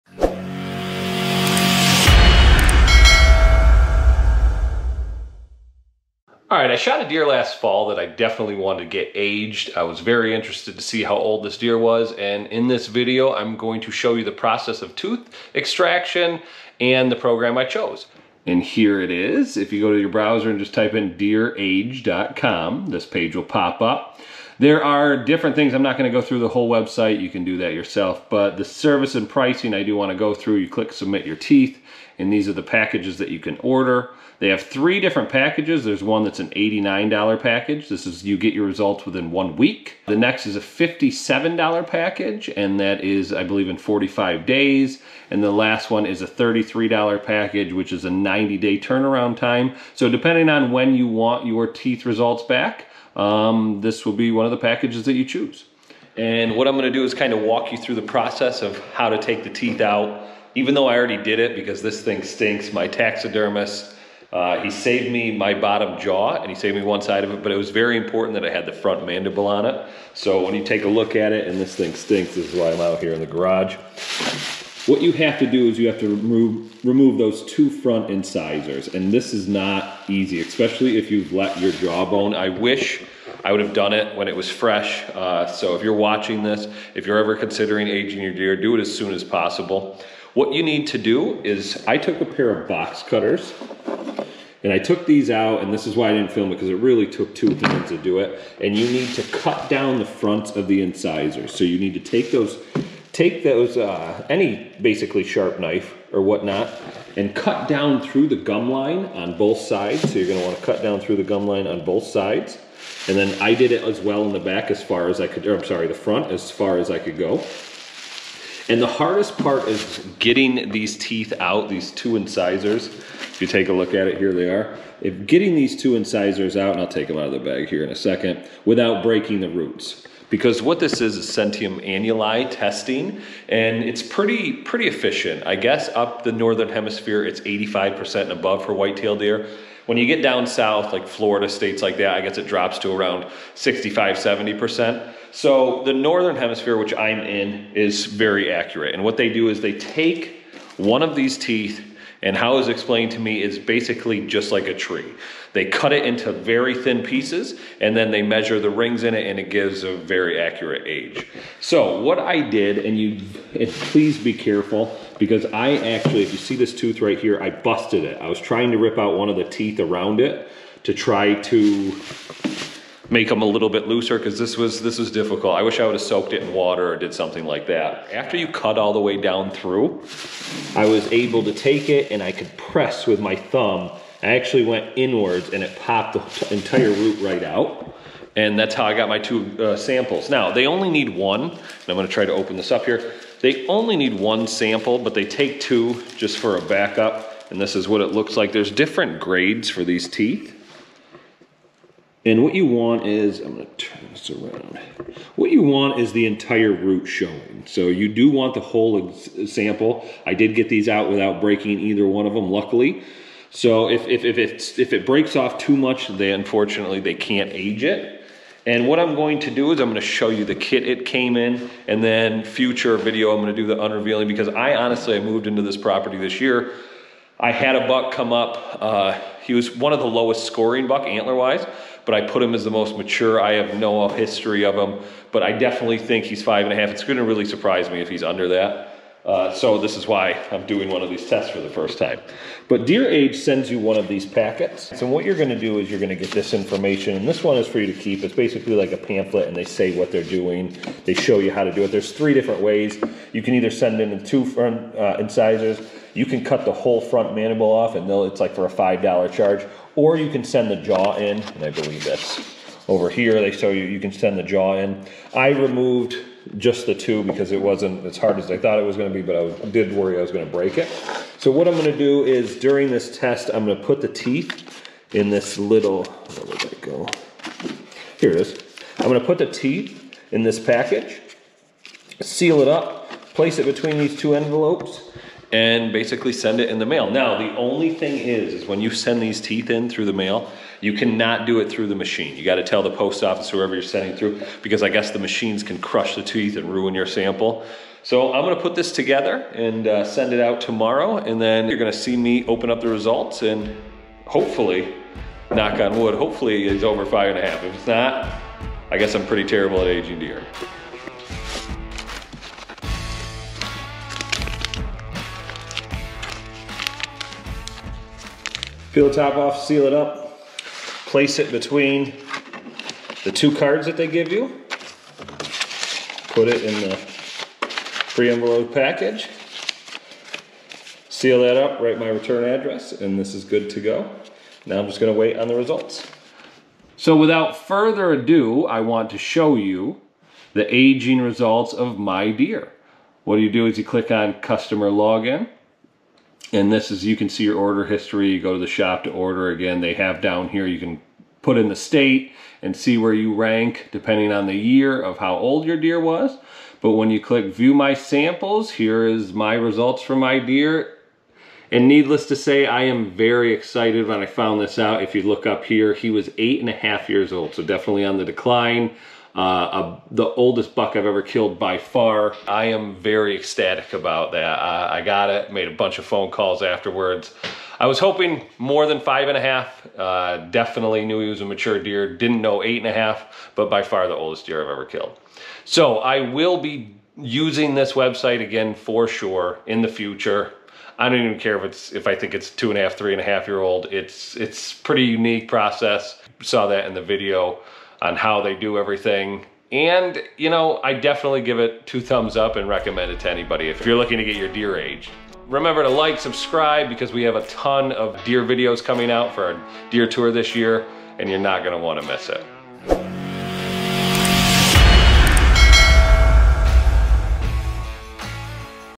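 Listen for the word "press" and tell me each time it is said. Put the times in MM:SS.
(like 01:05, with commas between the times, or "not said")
03:02.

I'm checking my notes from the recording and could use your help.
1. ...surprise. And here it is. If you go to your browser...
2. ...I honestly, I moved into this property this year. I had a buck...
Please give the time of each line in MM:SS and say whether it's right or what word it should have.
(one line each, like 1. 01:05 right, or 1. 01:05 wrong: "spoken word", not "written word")
1. 00:17 wrong: "chose", not "surprise"
2. 03:44 right.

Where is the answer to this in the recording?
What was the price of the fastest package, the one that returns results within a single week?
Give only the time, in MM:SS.
00:36.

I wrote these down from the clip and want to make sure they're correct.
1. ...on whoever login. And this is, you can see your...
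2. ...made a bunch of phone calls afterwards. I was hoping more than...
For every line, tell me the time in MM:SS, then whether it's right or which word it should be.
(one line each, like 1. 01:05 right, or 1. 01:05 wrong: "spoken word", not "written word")
1. 05:44 wrong: "customer", not "whoever"
2. 06:15 right.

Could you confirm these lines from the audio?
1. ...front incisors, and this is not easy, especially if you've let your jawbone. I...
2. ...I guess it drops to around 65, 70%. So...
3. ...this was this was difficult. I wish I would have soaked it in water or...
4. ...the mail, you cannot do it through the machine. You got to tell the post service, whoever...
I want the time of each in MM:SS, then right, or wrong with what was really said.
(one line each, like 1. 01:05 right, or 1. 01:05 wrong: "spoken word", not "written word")
1. 01:17 right
2. 02:22 right
3. 02:54 right
4. 04:50 wrong: "office", not "service".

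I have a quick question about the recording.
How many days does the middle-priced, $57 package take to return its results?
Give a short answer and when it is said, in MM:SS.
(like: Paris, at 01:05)
45 days, at 00:43.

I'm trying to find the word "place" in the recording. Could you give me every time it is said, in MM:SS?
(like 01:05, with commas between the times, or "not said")
04:43, 05:21.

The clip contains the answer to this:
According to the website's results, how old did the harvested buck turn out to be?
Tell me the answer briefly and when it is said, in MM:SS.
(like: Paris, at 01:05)
8.5 years, at 06:06.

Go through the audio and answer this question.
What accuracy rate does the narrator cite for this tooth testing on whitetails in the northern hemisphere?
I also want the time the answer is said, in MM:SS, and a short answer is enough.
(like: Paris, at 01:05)
85%, at 02:17.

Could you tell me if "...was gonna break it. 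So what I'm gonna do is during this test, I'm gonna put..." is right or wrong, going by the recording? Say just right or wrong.
right.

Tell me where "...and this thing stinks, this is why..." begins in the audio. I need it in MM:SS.
01:11.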